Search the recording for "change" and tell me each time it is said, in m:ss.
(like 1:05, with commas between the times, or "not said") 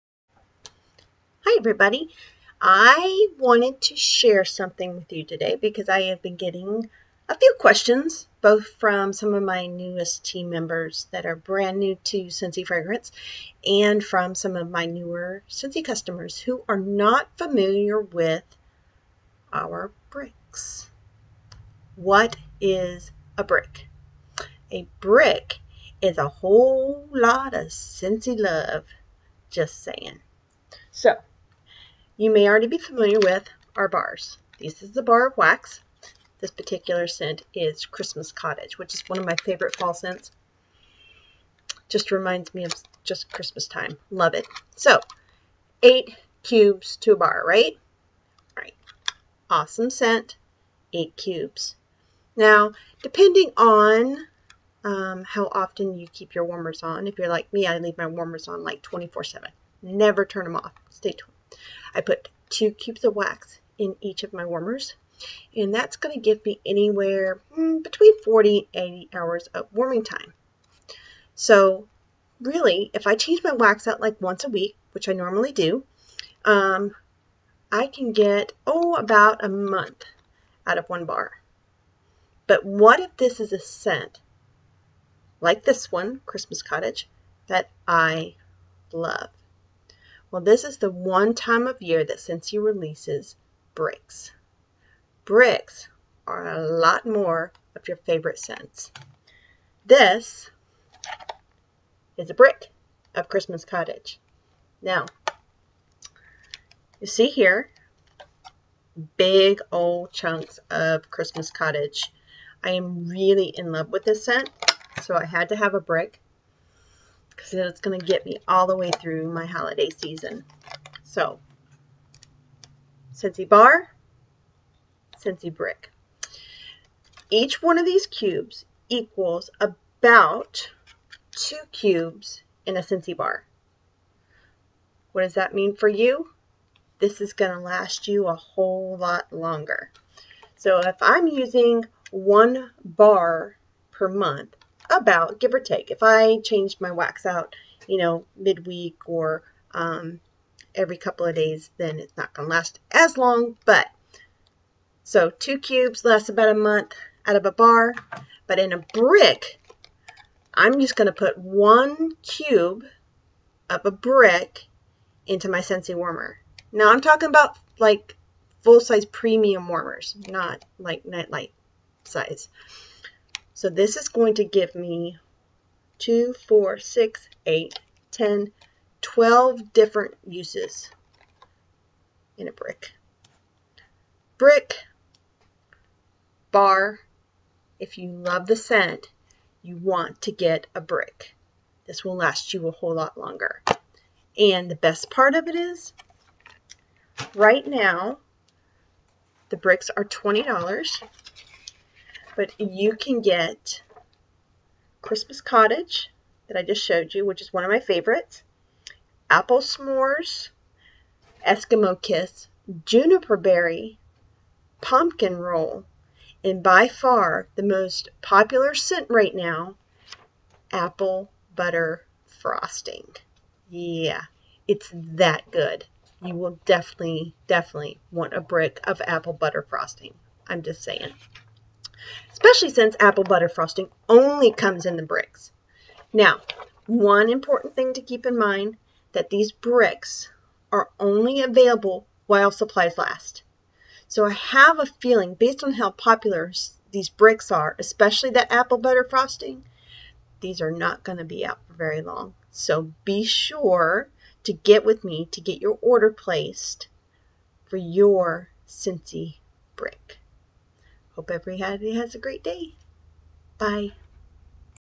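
1:13, 2:26.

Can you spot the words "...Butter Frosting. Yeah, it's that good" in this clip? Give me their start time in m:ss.
3:41.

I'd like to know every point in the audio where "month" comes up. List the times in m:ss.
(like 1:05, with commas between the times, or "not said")
1:19, 2:24, 2:36.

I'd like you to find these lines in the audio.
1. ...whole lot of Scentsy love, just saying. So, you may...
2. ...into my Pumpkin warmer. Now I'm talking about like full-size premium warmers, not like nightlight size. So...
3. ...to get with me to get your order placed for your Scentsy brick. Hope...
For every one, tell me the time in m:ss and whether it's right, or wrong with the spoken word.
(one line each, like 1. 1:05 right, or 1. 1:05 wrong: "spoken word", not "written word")
1. 0:26 right
2. 2:45 wrong: "Scentsy", not "Pumpkin"
3. 4:14 right.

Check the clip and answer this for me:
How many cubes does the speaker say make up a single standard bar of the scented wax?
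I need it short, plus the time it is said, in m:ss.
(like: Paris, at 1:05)
8, at 0:45.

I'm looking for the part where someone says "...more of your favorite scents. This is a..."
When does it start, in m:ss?
1:37.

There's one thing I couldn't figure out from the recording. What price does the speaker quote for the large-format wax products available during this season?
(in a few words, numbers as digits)
$20.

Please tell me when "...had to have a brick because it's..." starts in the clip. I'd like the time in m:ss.
1:55.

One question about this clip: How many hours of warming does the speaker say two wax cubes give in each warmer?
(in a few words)
40 to 80 hours.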